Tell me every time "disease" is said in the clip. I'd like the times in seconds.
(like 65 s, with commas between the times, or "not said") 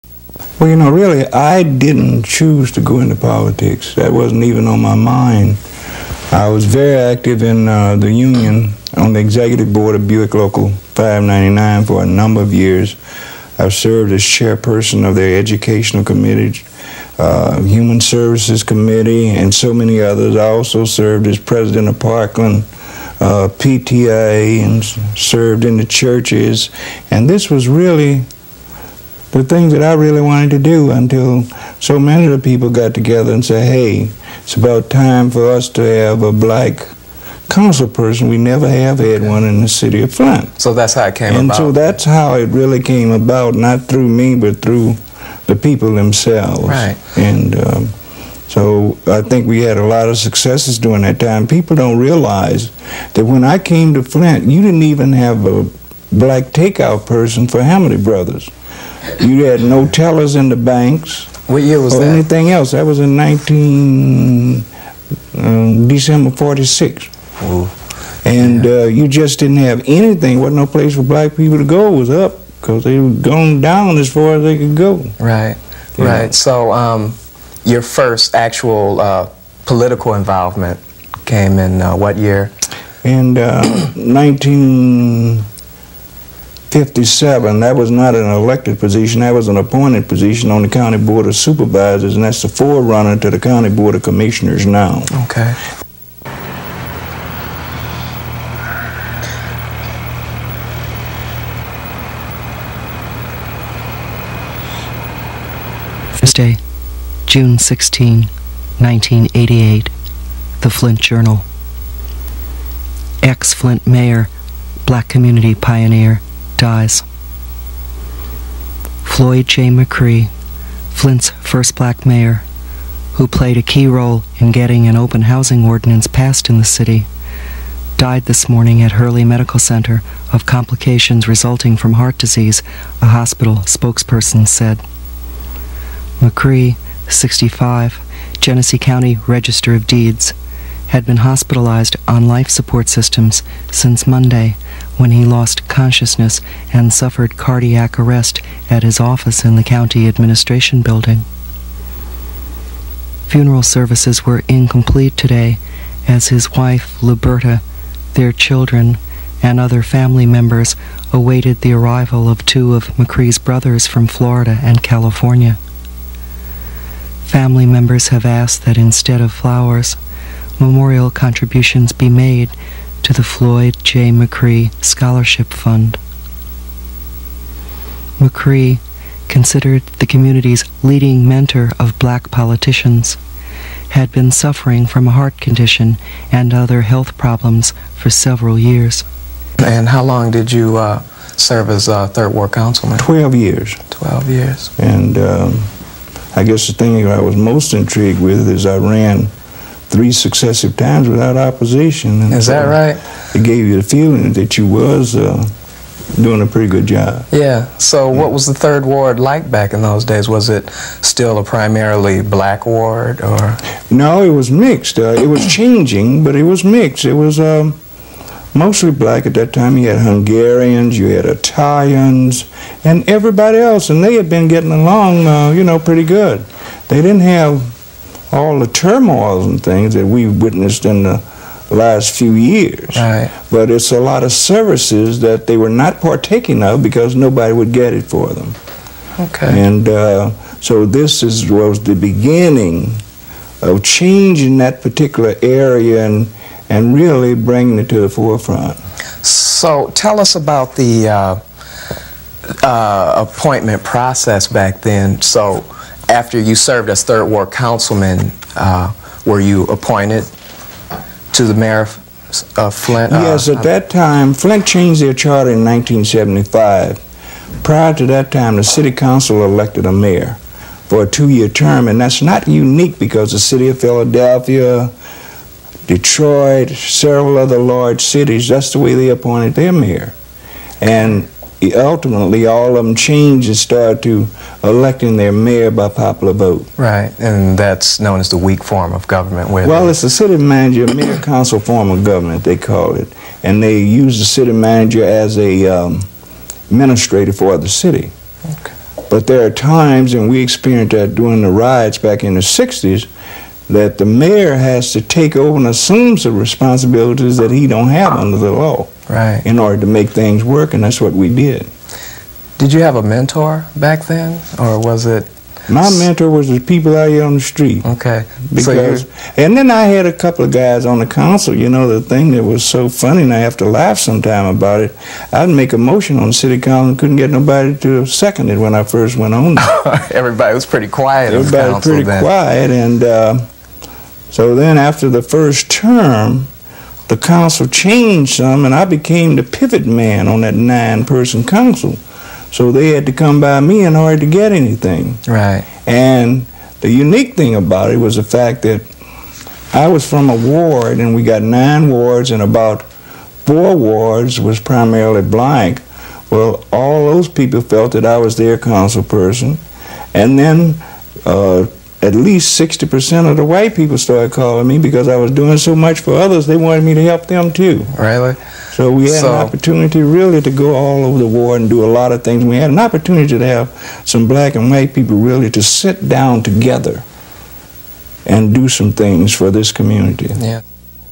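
132 s.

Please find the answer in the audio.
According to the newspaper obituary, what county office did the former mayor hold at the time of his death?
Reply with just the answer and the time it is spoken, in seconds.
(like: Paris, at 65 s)
Register of Deeds, at 139 s.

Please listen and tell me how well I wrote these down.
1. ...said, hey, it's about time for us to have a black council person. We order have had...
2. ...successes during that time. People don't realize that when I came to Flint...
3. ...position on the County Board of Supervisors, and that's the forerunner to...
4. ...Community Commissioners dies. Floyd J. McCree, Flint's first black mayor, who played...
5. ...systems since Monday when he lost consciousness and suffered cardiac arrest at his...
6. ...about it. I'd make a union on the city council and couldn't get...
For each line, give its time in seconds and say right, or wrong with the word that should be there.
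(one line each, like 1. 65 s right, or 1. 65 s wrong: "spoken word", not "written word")
1. 33 s wrong: "never", not "order"
2. 50 s right
3. 90 s right
4. 115 s wrong: "Pioneer", not "Commissioners"
5. 142 s right
6. 324 s wrong: "motion", not "union".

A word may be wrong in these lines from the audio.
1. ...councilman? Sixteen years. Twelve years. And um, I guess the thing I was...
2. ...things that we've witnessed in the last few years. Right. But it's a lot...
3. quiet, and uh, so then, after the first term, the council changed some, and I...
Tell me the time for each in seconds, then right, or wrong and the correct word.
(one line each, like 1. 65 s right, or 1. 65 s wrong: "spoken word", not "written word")
1. 192 s wrong: "Twelve", not "Sixteen"
2. 229 s right
3. 332 s right.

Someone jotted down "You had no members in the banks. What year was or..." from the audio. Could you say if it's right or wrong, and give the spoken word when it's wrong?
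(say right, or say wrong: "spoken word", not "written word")
wrong: "tellers", not "members".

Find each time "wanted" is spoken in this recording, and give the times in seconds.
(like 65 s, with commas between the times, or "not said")
30 s, 366 s.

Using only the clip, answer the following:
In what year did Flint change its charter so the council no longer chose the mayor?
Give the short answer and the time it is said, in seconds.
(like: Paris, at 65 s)
1975, at 265 s.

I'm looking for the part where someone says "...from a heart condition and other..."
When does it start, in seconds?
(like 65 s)
184 s.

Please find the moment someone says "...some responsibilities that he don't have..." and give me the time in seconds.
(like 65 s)
306 s.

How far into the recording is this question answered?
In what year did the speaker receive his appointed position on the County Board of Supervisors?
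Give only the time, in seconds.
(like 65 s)
86 s.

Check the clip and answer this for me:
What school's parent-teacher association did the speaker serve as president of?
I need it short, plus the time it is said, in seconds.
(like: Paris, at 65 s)
Parkland, at 21 s.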